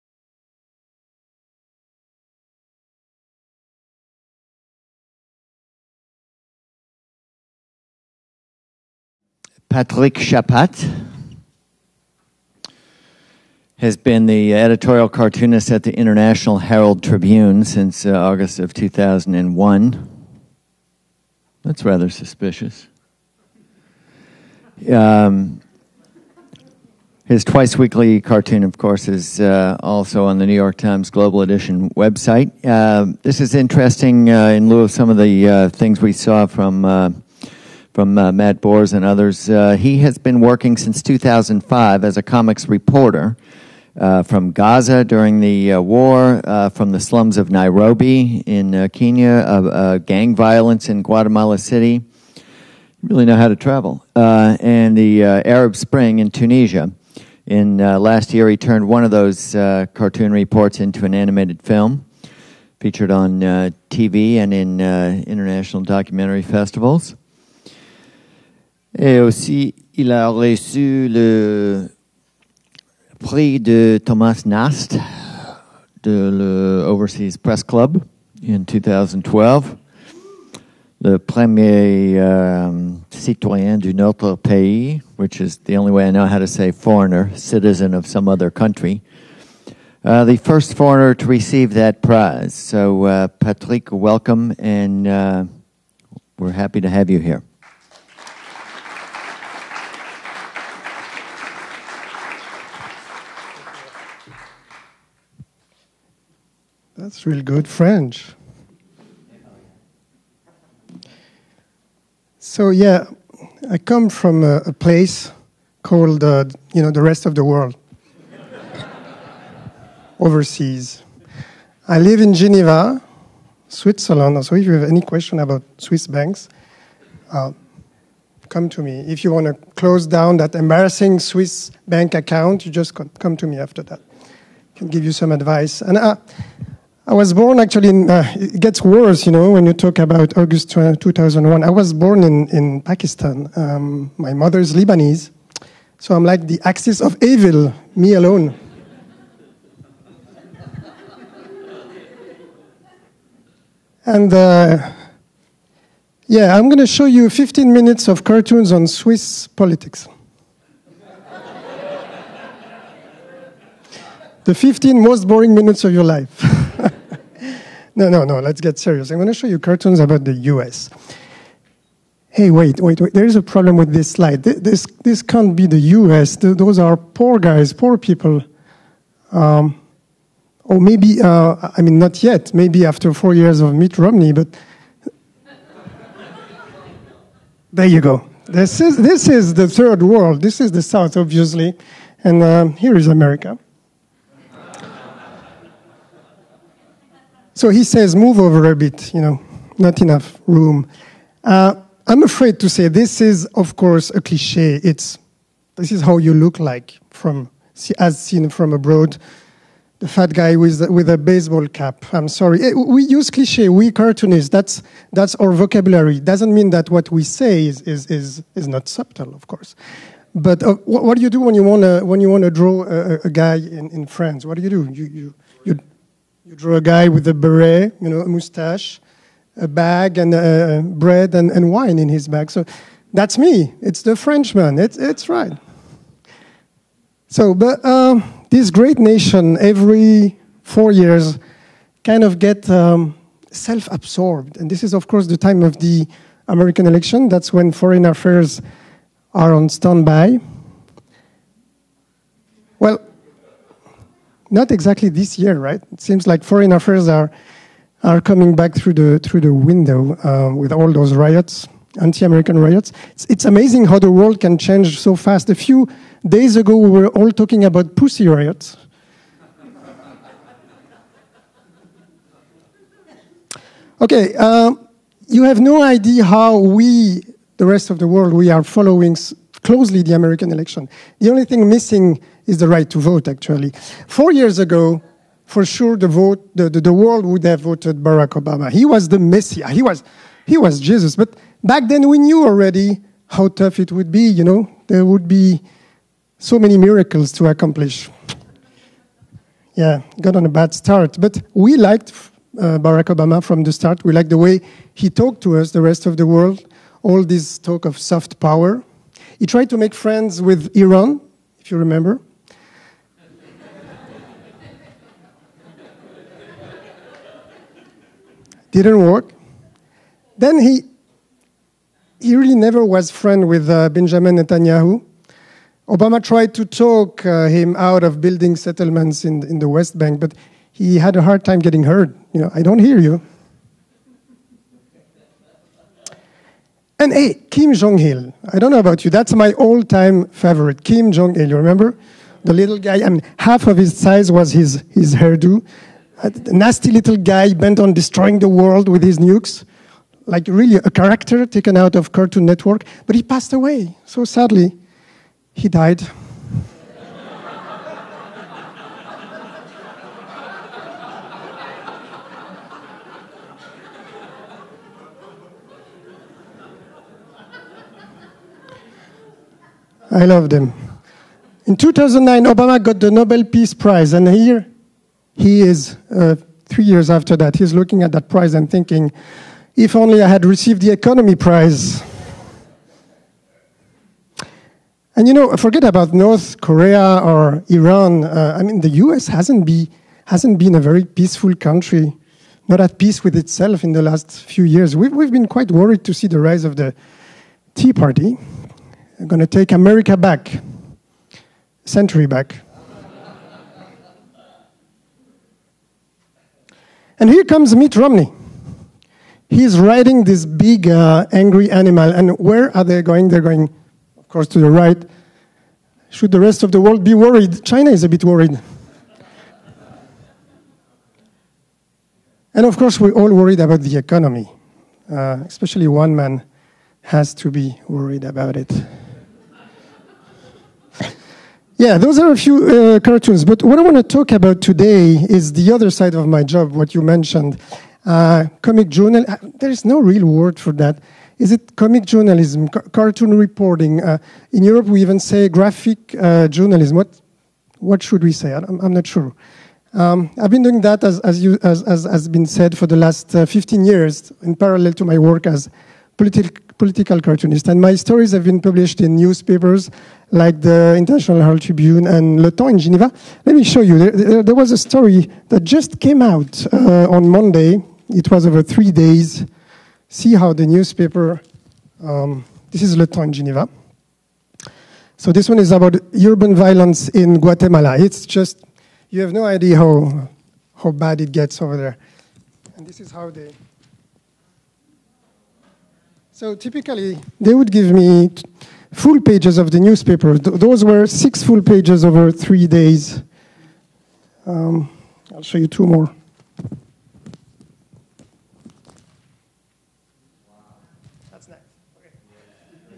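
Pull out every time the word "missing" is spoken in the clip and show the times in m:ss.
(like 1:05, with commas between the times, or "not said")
4:41.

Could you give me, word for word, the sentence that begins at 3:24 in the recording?
It's, this is how you look like from, as seen from abroad.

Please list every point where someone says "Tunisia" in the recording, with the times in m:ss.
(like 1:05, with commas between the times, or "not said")
0:56.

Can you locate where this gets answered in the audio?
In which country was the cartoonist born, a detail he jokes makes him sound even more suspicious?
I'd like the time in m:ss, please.
2:22.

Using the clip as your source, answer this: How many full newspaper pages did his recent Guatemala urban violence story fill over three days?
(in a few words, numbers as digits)
6.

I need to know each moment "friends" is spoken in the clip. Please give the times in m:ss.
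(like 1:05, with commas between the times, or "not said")
5:09, 5:23.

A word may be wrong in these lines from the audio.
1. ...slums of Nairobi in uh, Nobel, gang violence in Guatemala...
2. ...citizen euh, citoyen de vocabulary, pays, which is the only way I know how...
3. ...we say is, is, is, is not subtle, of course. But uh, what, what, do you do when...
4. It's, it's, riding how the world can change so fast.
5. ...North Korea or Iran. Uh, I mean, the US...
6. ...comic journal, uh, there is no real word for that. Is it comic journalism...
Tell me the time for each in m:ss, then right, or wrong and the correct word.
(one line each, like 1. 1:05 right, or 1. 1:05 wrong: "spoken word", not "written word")
1. 0:46 wrong: "Kenya", not "Nobel"
2. 1:22 wrong: "country", not "vocabulary"
3. 3:37 right
4. 4:23 wrong: "amazing", not "riding"
5. 6:26 right
6. 7:18 right.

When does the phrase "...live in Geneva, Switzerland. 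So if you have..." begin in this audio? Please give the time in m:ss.
2:01.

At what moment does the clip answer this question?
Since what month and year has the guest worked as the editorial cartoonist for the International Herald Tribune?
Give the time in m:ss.
0:18.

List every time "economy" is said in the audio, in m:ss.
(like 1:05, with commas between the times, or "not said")
6:20, 7:03.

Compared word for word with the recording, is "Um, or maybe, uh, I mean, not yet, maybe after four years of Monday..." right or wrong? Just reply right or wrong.
wrong.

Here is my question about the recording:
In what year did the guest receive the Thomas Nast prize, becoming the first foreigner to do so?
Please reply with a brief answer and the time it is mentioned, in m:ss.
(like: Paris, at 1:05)
2012, at 1:18.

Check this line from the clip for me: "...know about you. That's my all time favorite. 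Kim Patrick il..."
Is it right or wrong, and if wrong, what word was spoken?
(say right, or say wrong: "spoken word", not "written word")
wrong: "Jong", not "Patrick".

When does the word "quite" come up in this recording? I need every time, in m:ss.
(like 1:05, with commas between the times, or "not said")
6:35.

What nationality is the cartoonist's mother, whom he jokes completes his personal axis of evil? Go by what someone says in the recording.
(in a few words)
Lebanese.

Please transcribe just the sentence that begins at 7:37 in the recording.
And my stories have been published in newspapers, like the International Herald Tribune and Le Temps in Geneva.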